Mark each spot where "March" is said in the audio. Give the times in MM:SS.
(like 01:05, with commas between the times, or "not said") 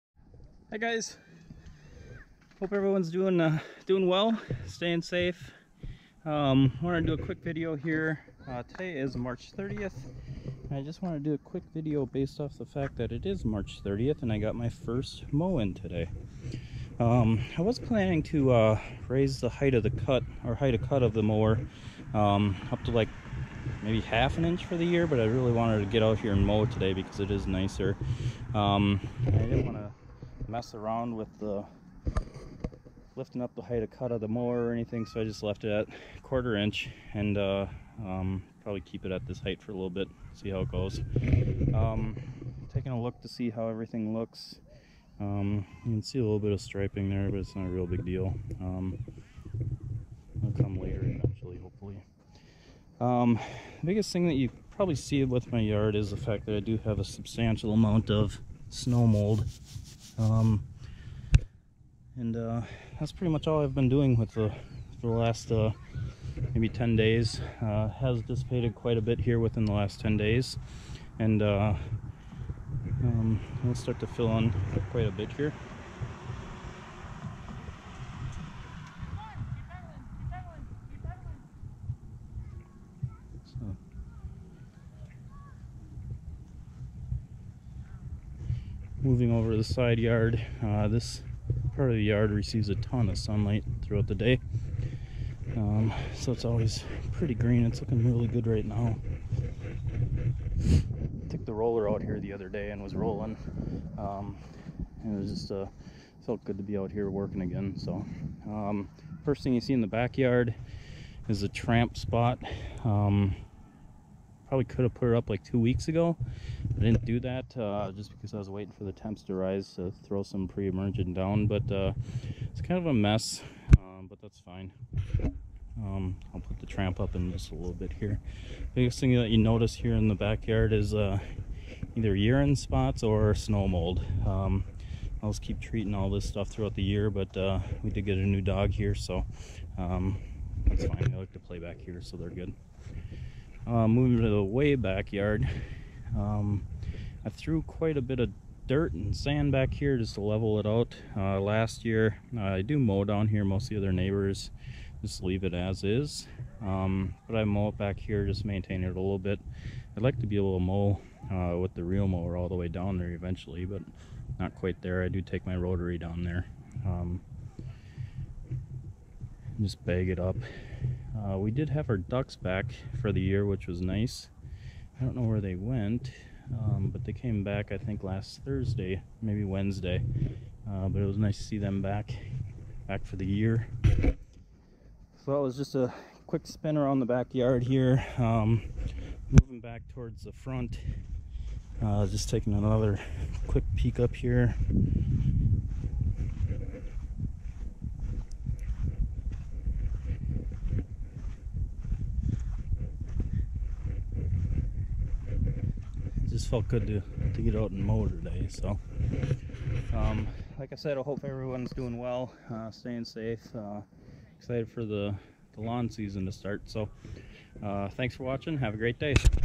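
00:09, 00:13.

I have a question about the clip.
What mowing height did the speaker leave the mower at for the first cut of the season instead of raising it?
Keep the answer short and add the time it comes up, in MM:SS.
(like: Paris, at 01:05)
1/4 inch, at 00:36.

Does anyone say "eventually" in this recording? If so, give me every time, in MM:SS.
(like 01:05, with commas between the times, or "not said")
00:51, 02:43.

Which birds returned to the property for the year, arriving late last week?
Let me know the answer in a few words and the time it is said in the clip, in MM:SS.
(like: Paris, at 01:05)
Ducks, at 02:51.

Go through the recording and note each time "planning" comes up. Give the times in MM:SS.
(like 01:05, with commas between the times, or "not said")
00:17.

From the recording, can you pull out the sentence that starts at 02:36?
Um, but I mow it back here, just maintain it a little bit.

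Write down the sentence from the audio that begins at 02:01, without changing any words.
But uh, it's kind of a mess, um, but that's fine.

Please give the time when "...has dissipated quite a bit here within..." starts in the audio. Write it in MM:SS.
01:07.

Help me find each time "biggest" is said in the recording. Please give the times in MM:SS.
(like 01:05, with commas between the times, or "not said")
00:53, 02:08.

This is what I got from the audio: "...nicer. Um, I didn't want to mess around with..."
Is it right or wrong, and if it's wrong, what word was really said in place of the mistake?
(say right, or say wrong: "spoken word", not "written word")
right.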